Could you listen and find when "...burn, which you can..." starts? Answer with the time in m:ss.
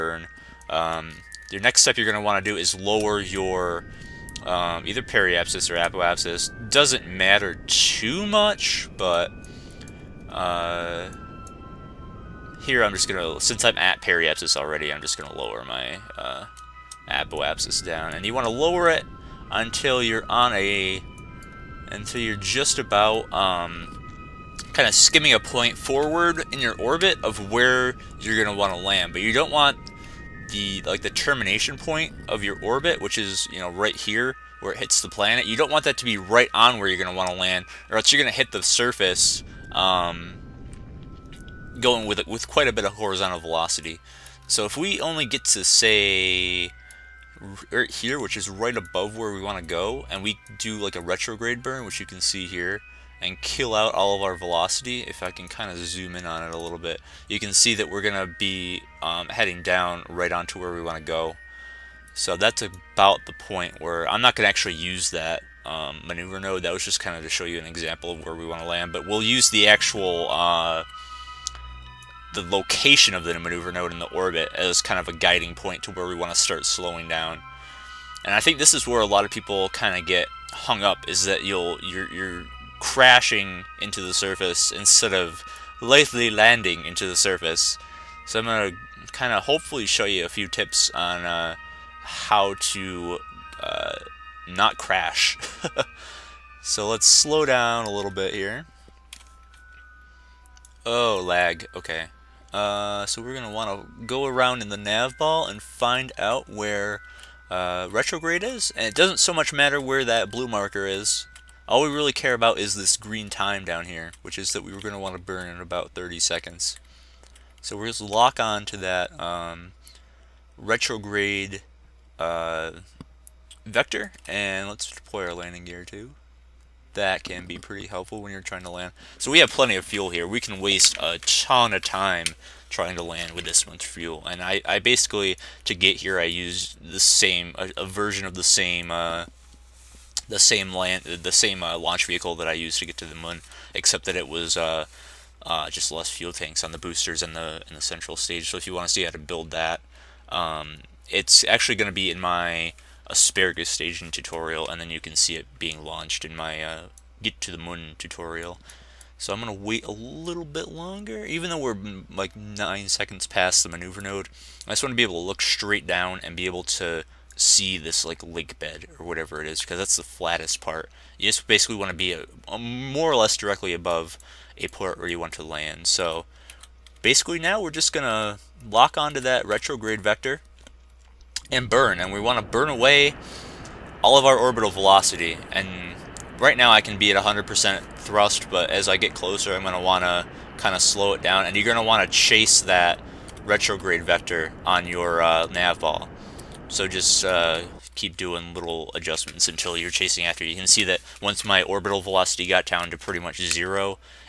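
0:51.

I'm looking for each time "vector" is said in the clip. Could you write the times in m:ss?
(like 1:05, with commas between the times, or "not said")
2:03, 3:00, 3:14.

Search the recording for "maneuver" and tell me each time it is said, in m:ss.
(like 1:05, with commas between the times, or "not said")
1:06, 1:13, 2:43.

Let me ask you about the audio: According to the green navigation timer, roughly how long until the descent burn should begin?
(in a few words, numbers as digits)
30 seconds.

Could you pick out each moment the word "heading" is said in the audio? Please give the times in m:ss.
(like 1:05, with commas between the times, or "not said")
0:59.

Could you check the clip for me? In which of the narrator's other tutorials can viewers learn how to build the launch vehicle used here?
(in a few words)
Asparagus staging tutorial.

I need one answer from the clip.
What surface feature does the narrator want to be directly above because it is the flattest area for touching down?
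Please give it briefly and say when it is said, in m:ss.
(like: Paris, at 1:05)
Lake bed, at 2:48.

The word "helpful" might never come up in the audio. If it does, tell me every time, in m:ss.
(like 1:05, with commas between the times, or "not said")
2:07.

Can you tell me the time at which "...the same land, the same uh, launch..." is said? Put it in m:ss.
2:20.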